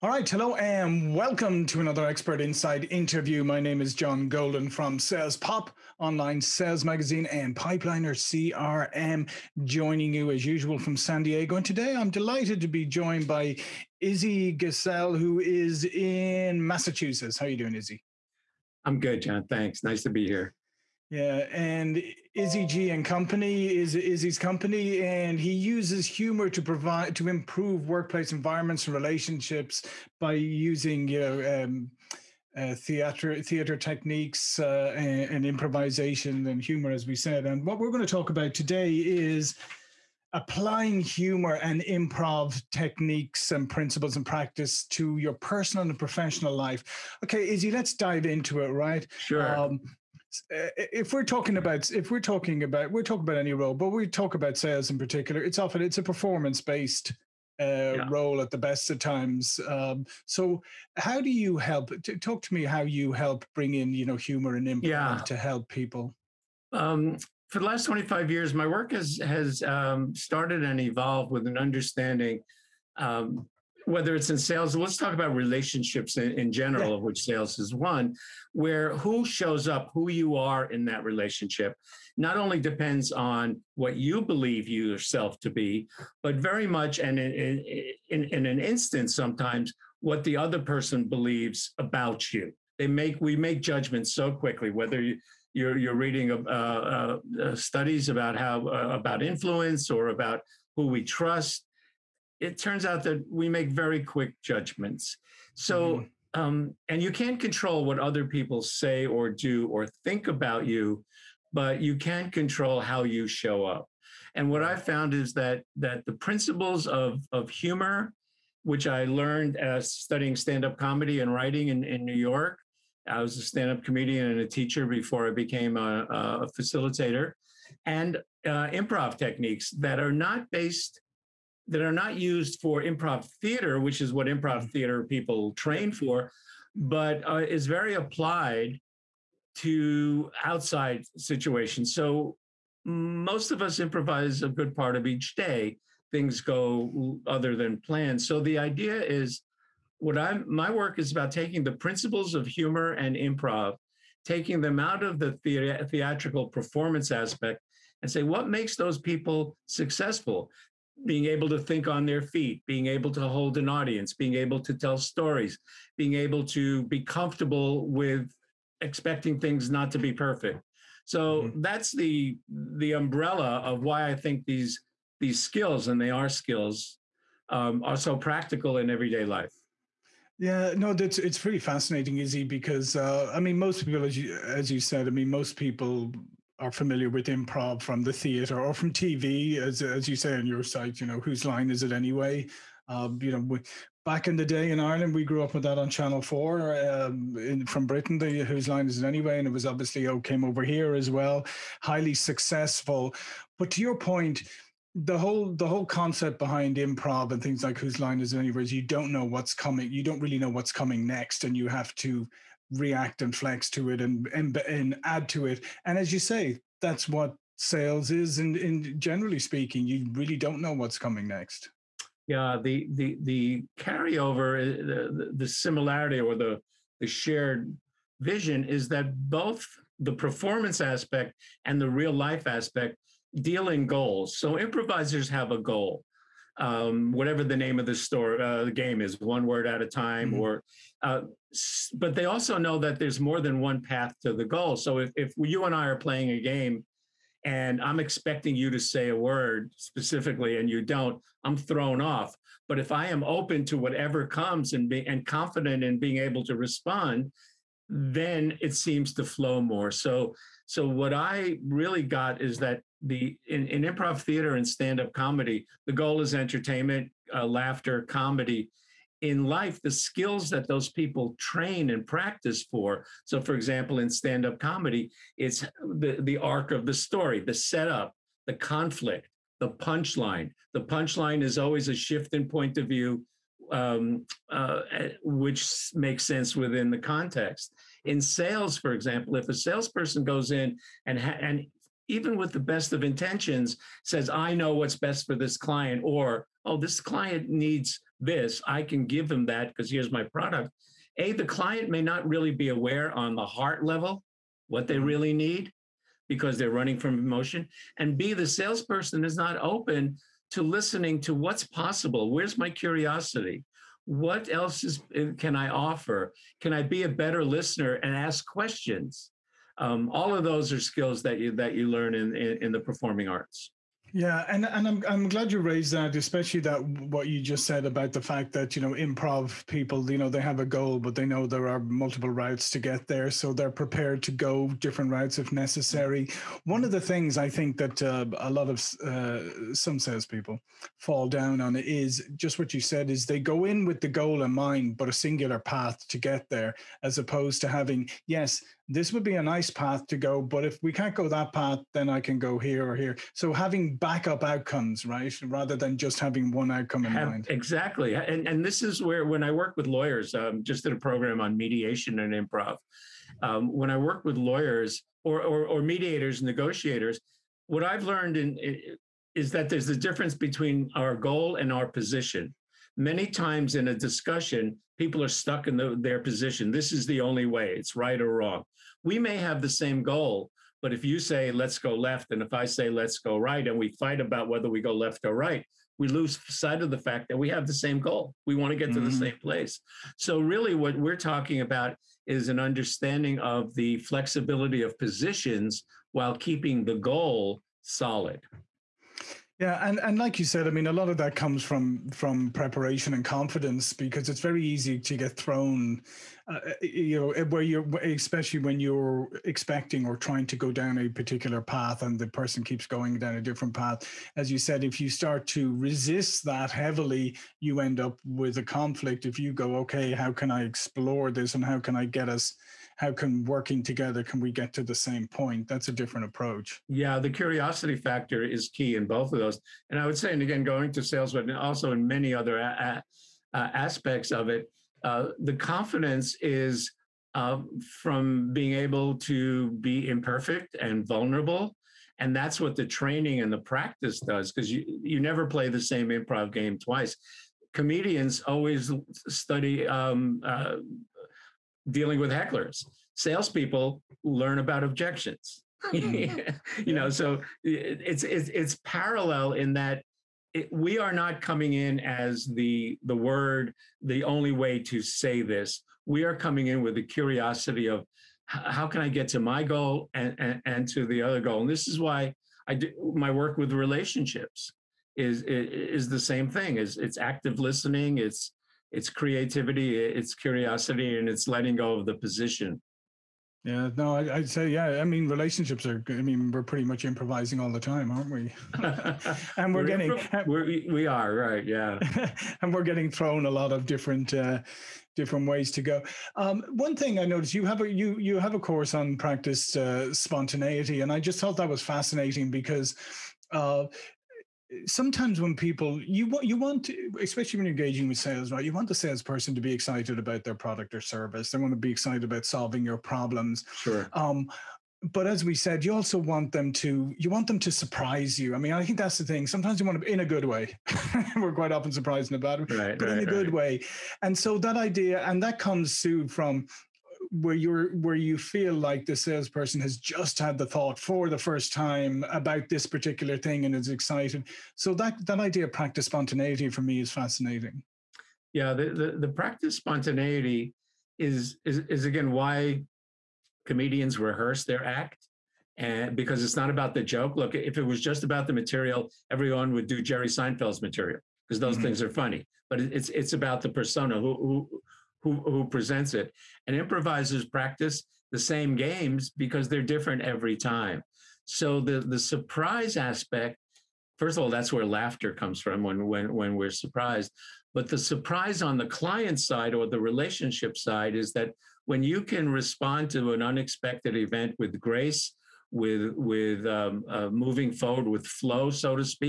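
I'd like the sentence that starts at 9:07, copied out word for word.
Look, if it was just about the material, everyone would do Jerry Seinfeld's material because those mm-hmm.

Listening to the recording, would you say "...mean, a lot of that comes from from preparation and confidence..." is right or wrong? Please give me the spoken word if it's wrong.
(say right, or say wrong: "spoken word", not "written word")
right.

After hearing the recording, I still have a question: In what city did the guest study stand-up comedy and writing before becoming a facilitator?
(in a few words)
New York.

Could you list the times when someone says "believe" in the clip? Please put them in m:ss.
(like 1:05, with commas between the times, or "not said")
1:24, 1:31.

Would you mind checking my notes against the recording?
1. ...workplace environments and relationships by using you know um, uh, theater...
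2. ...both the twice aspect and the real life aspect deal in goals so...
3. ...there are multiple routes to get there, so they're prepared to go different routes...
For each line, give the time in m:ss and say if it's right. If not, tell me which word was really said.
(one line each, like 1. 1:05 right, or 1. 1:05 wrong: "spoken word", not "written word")
1. 0:27 right
2. 3:49 wrong: "performance", not "twice"
3. 5:31 right.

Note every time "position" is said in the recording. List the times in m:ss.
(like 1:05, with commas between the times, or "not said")
6:11, 6:16, 6:34, 8:02.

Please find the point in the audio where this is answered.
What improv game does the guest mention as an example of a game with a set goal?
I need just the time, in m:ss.
3:59.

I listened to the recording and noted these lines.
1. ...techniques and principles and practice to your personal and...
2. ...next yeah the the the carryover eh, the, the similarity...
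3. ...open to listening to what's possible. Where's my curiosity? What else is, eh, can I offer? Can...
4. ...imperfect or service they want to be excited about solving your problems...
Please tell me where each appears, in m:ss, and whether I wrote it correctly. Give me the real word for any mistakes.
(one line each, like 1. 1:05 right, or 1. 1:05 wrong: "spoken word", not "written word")
1. 0:42 right
2. 3:41 right
3. 5:09 right
4. 8:30 wrong: "product", not "imperfect".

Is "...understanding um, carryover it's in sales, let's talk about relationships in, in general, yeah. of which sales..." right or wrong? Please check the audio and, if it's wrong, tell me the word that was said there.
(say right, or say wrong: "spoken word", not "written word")
wrong: "whether", not "carryover".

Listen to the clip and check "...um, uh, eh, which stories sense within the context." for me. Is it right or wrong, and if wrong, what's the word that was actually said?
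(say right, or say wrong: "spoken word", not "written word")
wrong: "makes", not "stories".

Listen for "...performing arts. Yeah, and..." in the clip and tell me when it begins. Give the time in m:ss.
5:22.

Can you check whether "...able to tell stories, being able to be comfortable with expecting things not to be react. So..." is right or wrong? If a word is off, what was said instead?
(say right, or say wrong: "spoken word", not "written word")
wrong: "perfect", not "react".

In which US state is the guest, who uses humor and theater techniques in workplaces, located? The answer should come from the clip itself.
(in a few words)
Massachusetts.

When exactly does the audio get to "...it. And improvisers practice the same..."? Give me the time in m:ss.
9:16.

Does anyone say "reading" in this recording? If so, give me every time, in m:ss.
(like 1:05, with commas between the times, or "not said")
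1:35.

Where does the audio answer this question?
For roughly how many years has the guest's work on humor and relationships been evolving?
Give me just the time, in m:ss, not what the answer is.
1:07.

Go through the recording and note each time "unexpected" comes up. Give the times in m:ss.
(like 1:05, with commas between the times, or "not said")
9:33.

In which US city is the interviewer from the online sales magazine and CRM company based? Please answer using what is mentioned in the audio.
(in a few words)
San Diego.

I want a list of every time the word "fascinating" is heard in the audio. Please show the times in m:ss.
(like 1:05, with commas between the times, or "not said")
3:01, 8:21, 8:57.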